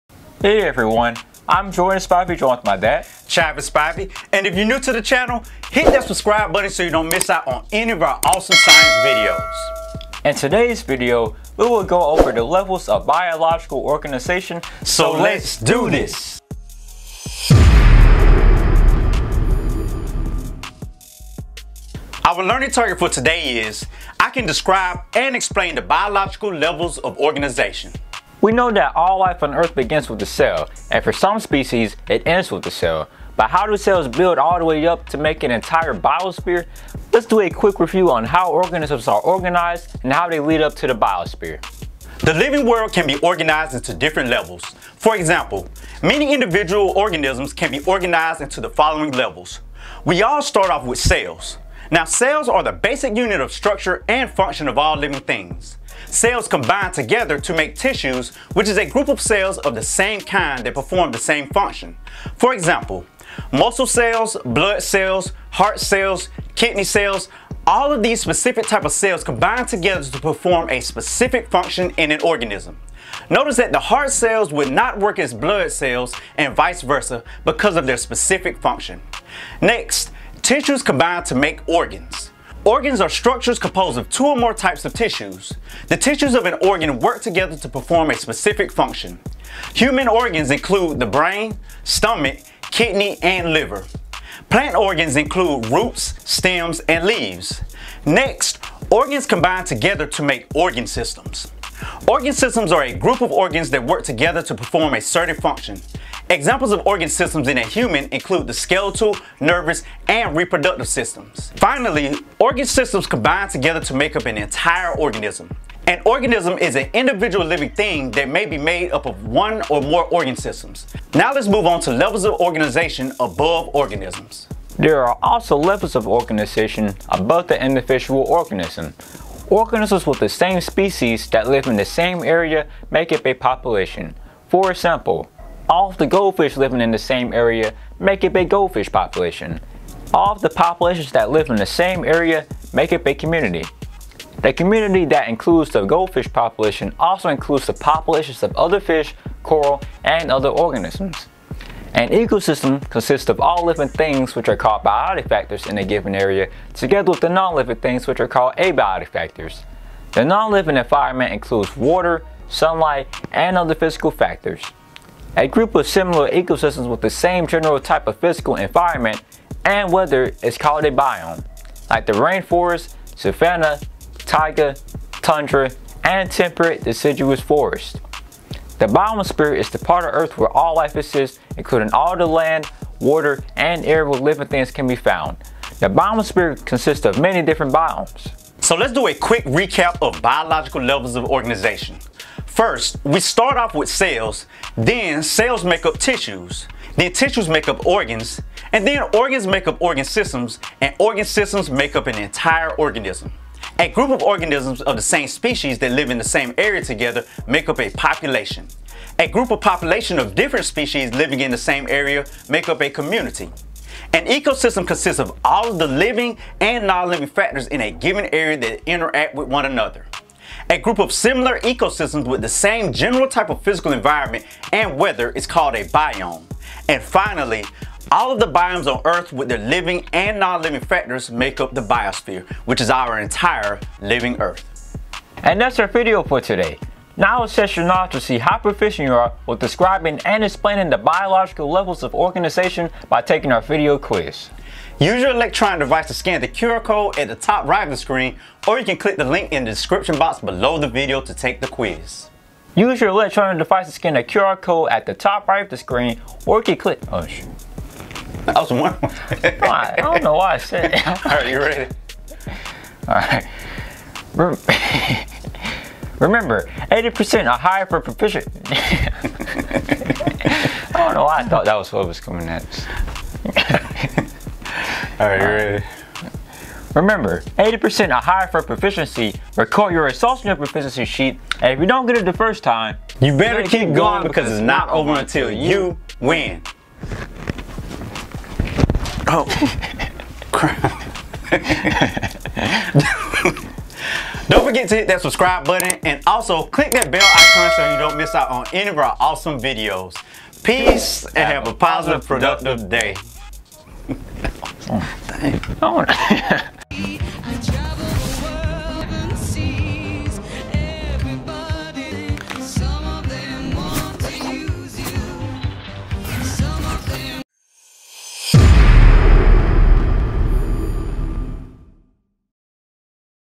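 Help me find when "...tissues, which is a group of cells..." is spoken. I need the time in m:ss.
0:57.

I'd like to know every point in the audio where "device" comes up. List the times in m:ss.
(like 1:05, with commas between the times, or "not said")
4:05, 4:13.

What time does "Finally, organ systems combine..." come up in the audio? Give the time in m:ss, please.
1:51.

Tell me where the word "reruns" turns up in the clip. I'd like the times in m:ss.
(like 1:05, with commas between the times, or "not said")
not said.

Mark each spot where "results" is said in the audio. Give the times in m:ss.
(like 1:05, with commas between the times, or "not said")
4:40.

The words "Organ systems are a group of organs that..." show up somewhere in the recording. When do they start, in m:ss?
1:42.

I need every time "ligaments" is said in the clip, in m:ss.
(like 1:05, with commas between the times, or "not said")
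not said.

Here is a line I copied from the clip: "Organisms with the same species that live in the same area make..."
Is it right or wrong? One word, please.
right.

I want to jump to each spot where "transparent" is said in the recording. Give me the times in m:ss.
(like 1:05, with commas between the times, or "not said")
not said.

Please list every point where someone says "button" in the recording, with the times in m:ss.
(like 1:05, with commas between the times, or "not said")
0:06, 4:55.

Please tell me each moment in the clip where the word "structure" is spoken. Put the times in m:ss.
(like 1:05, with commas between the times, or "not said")
0:53, 1:23.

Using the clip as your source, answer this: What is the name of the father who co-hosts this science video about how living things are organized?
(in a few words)
Chivas Spivey.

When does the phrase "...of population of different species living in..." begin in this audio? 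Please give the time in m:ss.
3:29.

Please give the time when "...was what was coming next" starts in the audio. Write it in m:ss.
4:31.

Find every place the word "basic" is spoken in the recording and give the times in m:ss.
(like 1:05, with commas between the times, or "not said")
0:52.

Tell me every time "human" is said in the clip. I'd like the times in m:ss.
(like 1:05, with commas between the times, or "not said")
1:29, 1:47.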